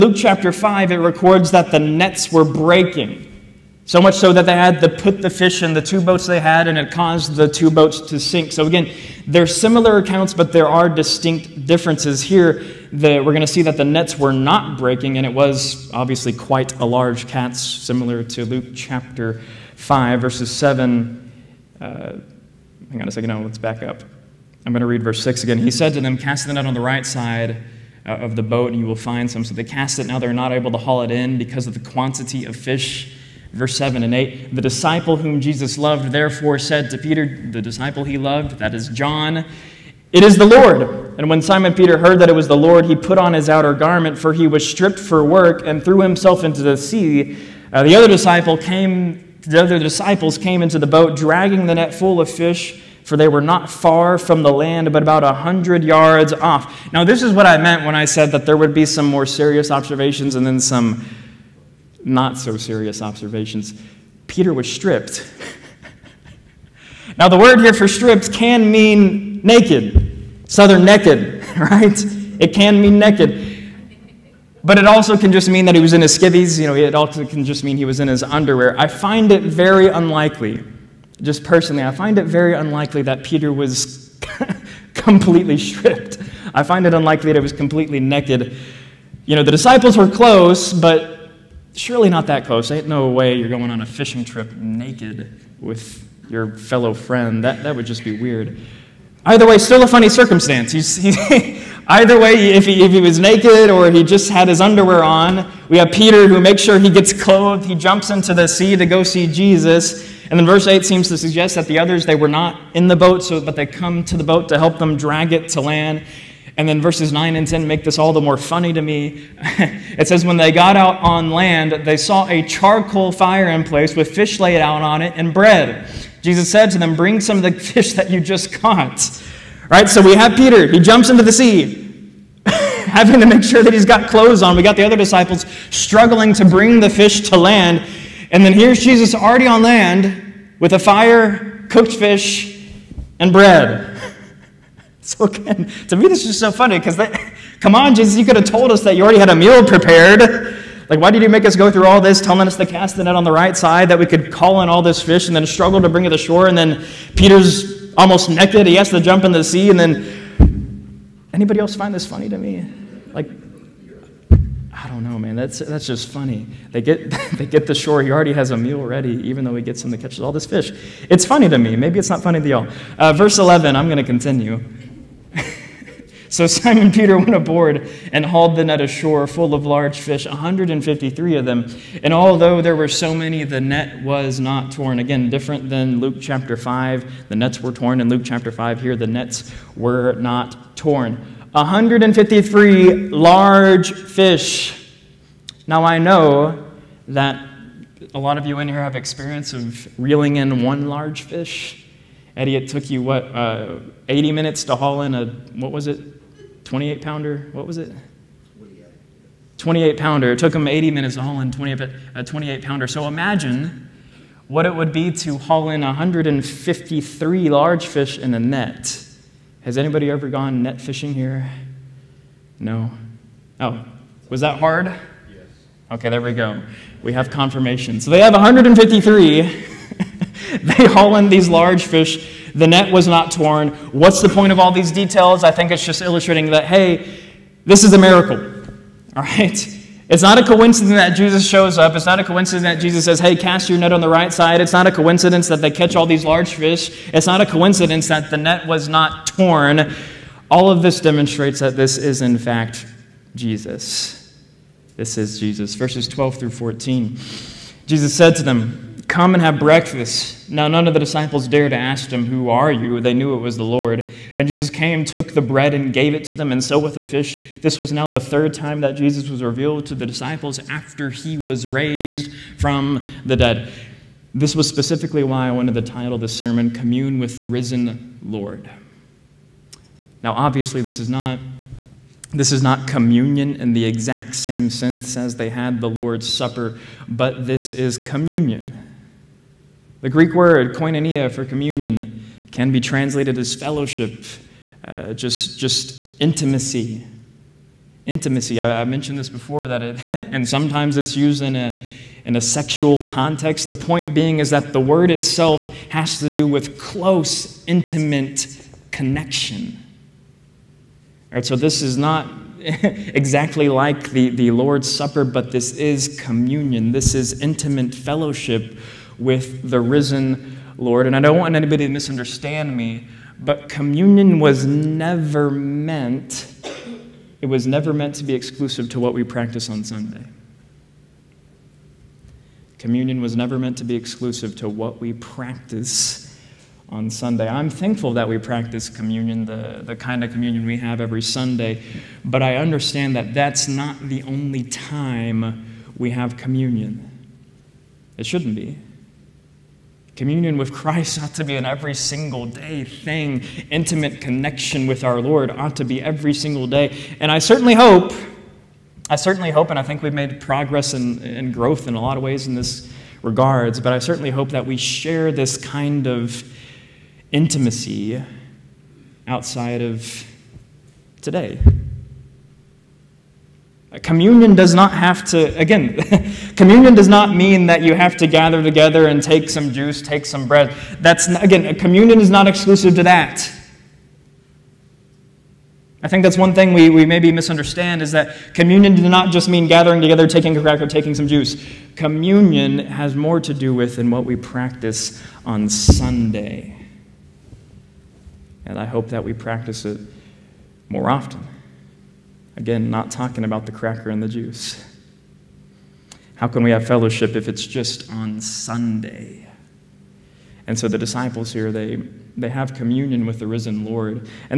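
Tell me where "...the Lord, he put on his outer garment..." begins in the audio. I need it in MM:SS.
00:42.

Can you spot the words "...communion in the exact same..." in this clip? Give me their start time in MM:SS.
04:42.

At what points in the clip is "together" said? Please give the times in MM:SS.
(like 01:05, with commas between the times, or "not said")
06:18, 06:30.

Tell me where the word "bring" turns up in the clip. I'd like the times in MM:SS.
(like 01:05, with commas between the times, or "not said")
02:06, 02:16, 02:35.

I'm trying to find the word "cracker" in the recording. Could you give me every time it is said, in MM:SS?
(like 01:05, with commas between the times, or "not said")
06:30, 06:43.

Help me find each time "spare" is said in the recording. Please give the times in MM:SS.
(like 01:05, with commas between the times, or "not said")
not said.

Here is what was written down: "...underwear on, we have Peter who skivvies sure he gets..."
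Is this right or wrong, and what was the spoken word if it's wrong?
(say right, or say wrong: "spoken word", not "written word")
wrong: "makes", not "skivvies".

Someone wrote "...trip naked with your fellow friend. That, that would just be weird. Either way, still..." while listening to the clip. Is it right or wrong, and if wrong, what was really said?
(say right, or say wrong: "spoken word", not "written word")
right.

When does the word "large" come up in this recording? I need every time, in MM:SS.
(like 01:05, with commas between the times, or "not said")
00:16, 02:59, 03:13, 03:20, 03:37, 03:51, 04:06.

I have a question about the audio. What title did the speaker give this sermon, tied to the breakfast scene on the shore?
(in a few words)
Commune with the Risen Lord.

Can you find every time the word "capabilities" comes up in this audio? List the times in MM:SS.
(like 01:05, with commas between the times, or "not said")
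not said.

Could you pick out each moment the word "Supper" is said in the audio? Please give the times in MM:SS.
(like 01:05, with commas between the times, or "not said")
04:46, 05:14.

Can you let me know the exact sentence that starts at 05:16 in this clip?
This is intimate fellowship with the risen Lord.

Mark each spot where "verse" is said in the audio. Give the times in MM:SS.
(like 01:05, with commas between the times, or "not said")
00:20, 00:25, 00:33, 01:50, 01:56, 02:53, 04:15.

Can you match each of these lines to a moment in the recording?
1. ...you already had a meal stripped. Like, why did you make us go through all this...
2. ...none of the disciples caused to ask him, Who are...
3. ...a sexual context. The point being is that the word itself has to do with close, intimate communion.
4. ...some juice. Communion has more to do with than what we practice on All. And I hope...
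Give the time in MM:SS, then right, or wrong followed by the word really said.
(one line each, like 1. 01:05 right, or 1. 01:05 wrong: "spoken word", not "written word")
1. 02:28 wrong: "prepared", not "stripped"
2. 04:20 wrong: "dared", not "caused"
3. 05:02 wrong: "connection", not "communion"
4. 06:31 wrong: "Sunday", not "All".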